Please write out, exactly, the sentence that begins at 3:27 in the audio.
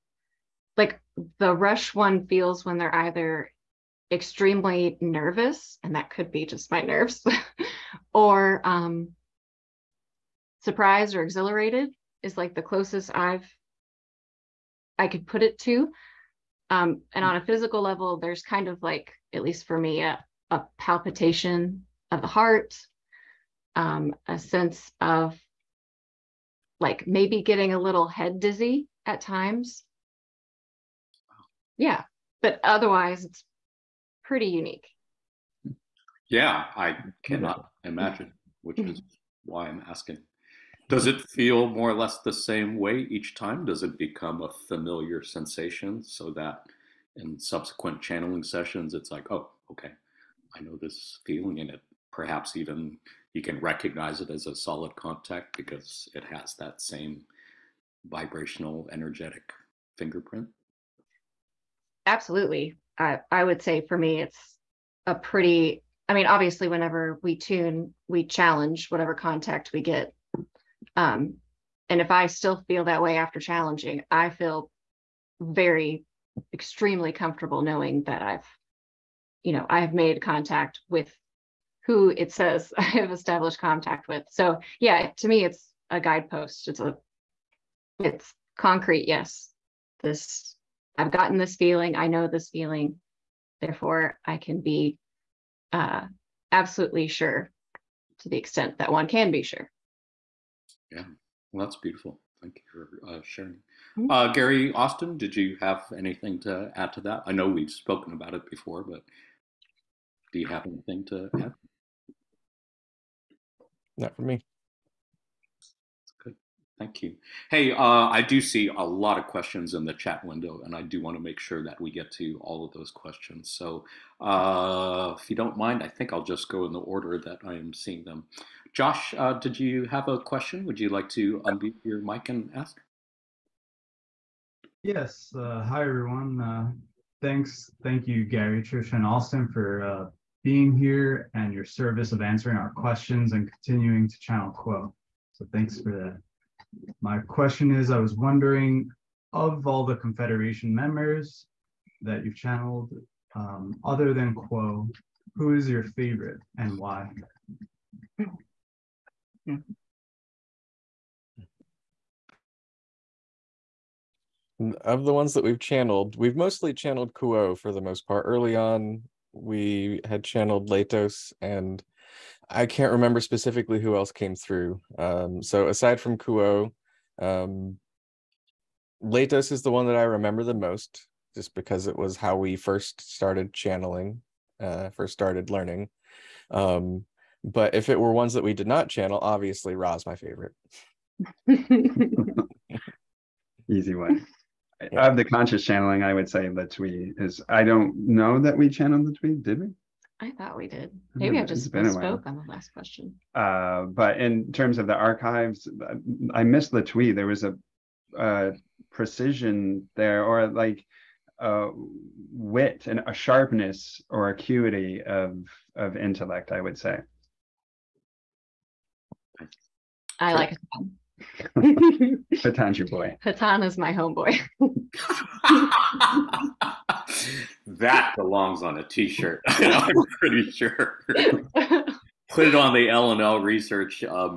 There was a, precision there, or like uh, wit and a sharpness or acuity of of intellect.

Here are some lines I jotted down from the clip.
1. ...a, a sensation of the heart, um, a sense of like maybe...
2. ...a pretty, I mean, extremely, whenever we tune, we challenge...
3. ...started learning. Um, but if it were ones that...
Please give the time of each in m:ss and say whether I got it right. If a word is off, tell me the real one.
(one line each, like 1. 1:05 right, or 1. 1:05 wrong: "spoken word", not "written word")
1. 0:20 wrong: "palpitation", not "sensation"
2. 1:05 wrong: "obviously", not "extremely"
3. 3:05 right.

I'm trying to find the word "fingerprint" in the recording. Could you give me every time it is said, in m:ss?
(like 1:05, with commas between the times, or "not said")
0:59.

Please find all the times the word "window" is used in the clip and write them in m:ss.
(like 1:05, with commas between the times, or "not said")
2:00.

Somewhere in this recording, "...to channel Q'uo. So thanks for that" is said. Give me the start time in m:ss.
2:24.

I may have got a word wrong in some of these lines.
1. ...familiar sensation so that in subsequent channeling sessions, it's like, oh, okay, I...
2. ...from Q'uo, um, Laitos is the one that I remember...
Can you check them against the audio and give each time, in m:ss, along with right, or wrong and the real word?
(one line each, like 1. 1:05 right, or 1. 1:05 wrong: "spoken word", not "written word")
1. 0:44 right
2. 2:55 right.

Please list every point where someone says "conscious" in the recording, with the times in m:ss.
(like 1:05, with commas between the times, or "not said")
3:15.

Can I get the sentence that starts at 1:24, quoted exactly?
So yeah, to me, it's a guidepost.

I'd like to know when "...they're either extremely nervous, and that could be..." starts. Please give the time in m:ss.
0:02.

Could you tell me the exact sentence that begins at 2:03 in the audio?
So, uh, if you don't mind, I think I'll just go in the order that I am seeing them.